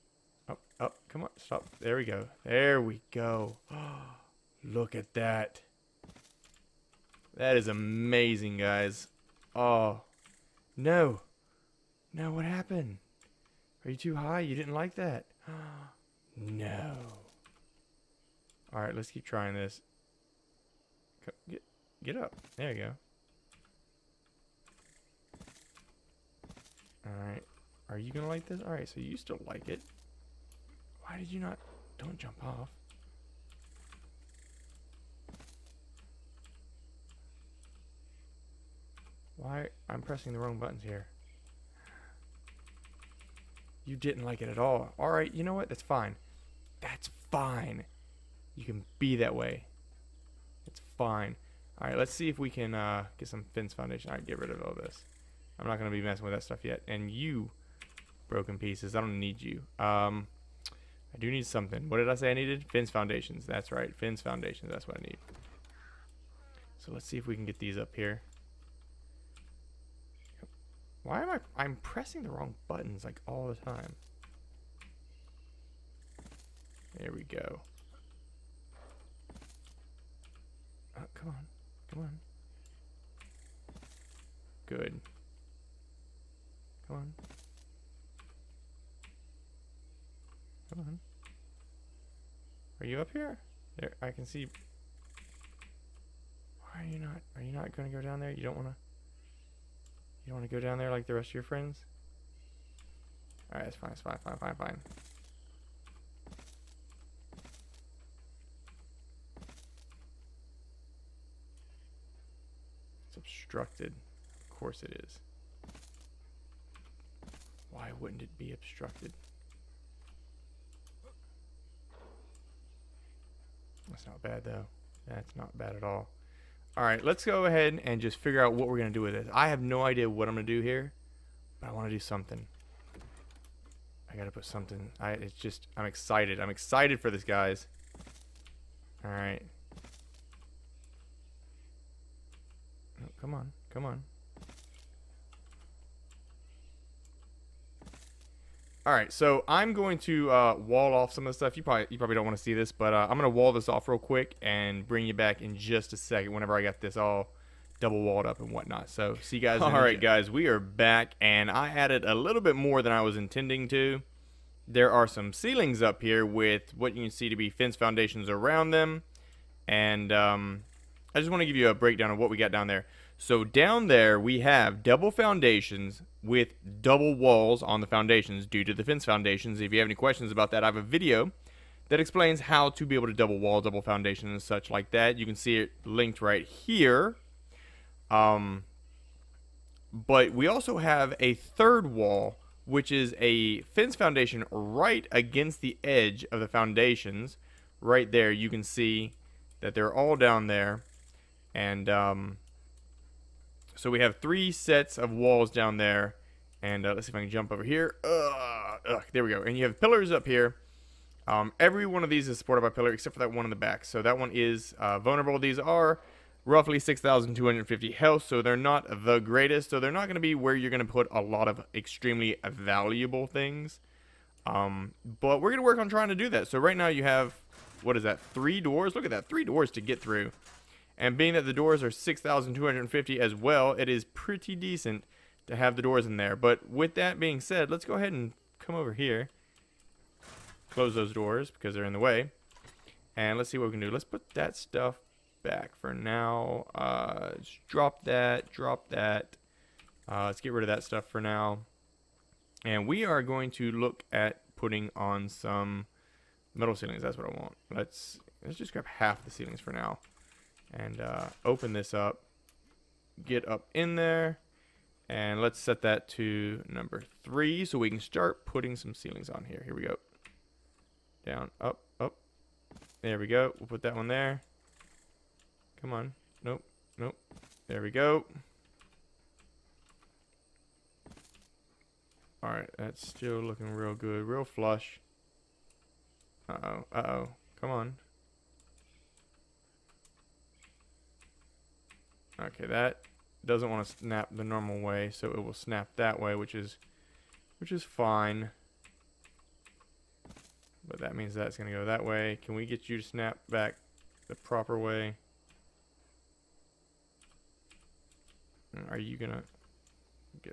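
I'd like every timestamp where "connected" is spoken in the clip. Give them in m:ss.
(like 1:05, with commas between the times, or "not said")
not said.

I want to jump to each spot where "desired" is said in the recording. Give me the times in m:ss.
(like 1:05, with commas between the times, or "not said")
not said.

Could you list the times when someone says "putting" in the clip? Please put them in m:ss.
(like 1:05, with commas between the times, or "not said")
4:14, 4:28.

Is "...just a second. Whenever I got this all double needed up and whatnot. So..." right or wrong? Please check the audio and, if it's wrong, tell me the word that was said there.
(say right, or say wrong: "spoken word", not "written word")
wrong: "walled", not "needed".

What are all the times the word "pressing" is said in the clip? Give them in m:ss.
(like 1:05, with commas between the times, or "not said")
0:40, 1:11.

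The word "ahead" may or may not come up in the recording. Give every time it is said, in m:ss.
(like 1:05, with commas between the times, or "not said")
2:07, 3:57.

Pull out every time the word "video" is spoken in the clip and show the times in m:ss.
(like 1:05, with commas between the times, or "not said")
3:00.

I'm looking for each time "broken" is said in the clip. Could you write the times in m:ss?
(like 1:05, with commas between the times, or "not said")
0:58.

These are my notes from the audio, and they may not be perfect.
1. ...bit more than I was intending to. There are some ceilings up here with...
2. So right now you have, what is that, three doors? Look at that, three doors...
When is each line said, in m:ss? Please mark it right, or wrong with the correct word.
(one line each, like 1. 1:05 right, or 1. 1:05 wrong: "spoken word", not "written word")
1. 2:42 right
2. 3:46 right.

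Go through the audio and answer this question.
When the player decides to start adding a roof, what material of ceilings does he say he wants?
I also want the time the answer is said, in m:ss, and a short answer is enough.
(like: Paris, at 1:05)
Metal, at 4:16.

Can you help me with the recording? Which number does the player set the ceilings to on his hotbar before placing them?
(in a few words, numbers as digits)
3.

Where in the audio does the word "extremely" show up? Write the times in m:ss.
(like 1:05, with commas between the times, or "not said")
3:41.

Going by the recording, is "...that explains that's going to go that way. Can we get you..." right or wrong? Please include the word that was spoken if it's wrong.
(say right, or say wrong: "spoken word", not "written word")
wrong: "means", not "explains".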